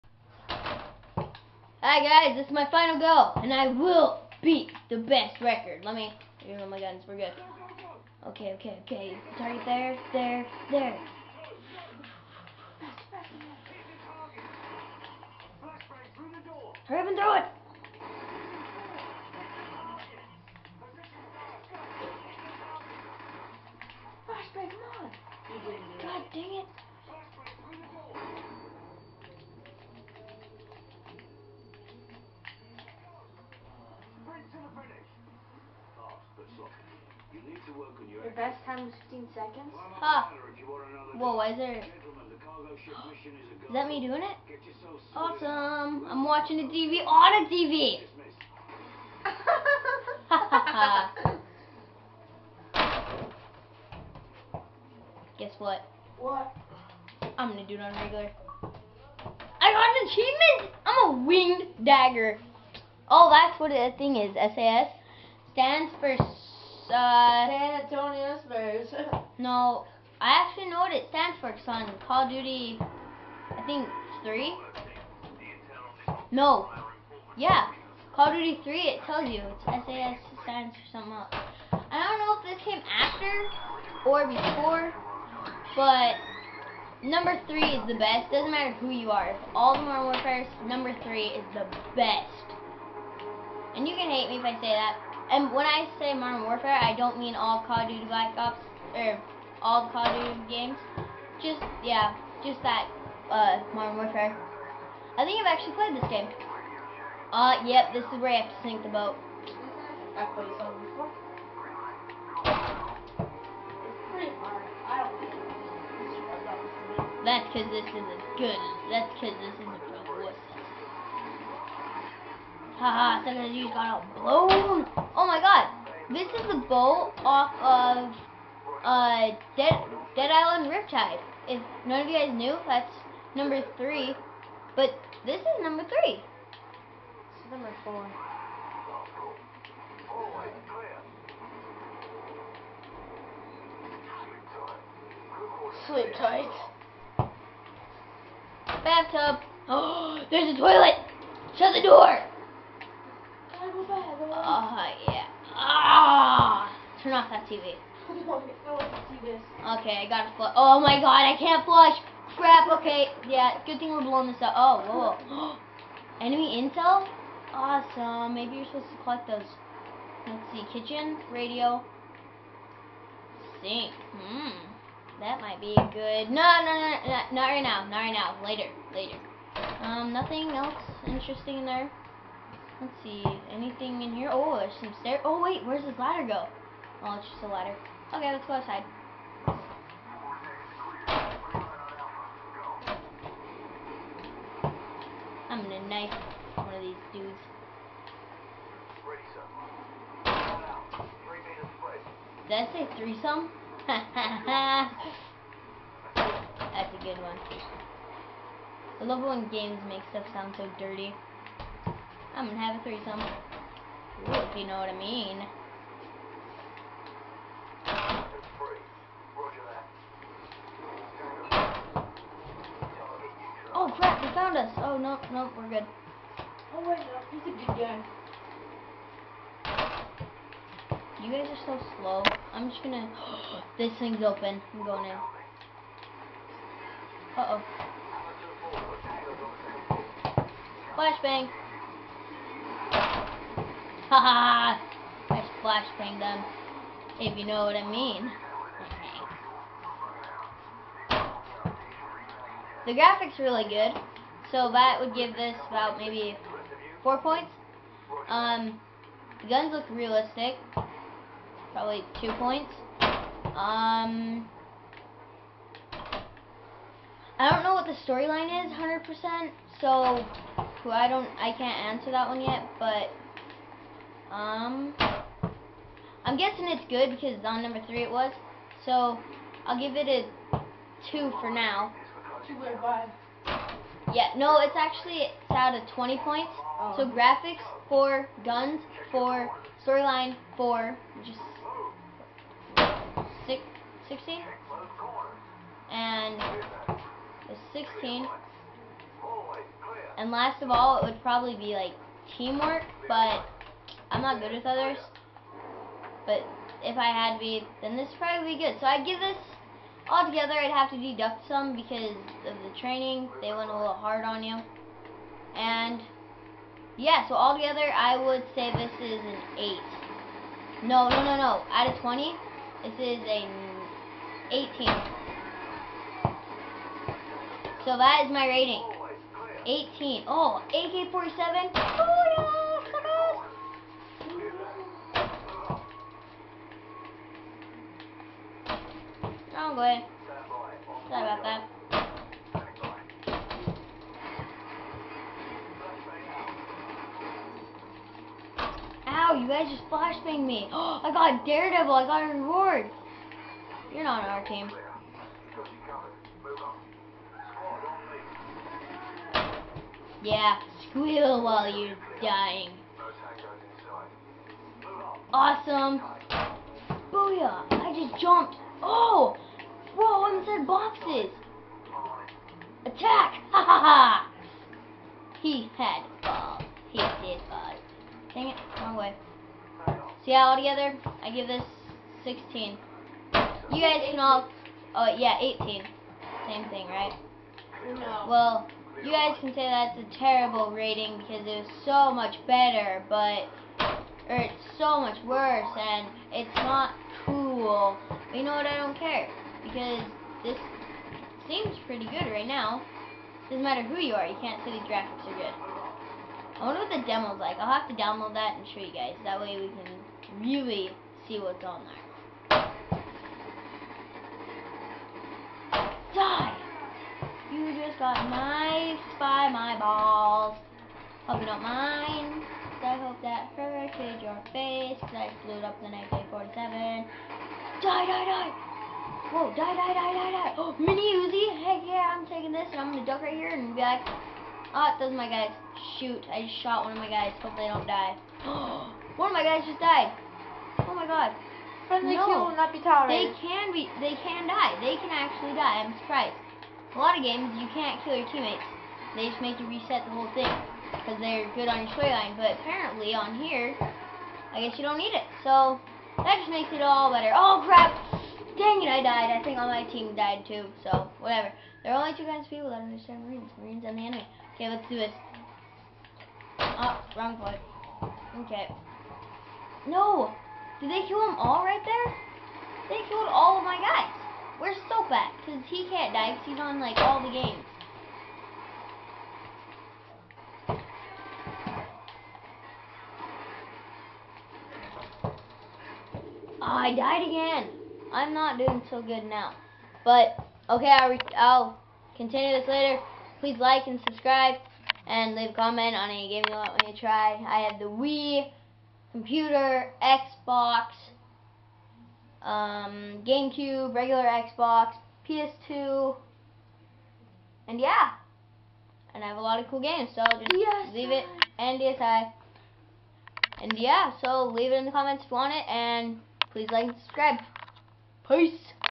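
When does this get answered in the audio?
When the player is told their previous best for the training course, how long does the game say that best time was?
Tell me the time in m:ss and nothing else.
0:39.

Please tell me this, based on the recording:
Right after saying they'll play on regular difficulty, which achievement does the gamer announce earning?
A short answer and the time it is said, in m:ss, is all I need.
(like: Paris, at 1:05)
Winged dagger, at 1:01.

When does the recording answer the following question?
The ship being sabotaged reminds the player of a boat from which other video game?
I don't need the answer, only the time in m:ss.
2:10.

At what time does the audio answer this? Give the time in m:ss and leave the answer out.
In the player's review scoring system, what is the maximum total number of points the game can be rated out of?
4:45.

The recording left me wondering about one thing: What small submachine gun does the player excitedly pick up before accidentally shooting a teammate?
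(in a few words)
Mini Uzi.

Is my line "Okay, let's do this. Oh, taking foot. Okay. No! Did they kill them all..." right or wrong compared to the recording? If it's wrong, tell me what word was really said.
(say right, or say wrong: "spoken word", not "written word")
wrong: "wrong", not "taking".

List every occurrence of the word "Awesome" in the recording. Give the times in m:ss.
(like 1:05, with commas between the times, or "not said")
0:45, 2:47, 6:05.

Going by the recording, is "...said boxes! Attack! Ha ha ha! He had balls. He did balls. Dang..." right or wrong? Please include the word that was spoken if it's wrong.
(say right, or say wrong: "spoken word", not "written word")
right.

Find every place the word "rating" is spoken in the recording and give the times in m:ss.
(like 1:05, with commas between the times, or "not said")
5:28, 6:30.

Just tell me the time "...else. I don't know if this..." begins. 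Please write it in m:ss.
1:21.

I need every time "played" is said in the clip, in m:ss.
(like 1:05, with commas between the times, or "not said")
1:45, 1:50.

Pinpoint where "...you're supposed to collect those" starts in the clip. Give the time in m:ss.
2:48.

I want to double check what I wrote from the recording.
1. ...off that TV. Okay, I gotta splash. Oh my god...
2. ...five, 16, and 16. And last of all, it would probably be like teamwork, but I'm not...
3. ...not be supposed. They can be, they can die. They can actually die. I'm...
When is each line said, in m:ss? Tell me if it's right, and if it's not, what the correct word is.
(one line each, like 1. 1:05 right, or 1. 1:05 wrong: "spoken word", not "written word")
1. 2:37 wrong: "flush", not "splash"
2. 4:53 wrong: "six", not "five"
3. 7:22 wrong: "tolerated", not "supposed".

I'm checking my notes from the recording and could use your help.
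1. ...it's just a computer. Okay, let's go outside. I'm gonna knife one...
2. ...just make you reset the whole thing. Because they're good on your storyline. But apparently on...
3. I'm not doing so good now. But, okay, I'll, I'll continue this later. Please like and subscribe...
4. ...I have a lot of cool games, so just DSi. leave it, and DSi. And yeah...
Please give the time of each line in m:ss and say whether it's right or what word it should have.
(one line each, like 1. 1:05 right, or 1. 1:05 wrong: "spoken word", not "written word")
1. 3:07 wrong: "ladder", not "computer"
2. 7:29 right
3. 8:08 right
4. 8:29 right.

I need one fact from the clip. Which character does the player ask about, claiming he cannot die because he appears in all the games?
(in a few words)
Soap.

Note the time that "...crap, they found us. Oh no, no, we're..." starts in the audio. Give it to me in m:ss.
3:43.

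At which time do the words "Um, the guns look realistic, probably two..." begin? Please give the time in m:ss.
4:18.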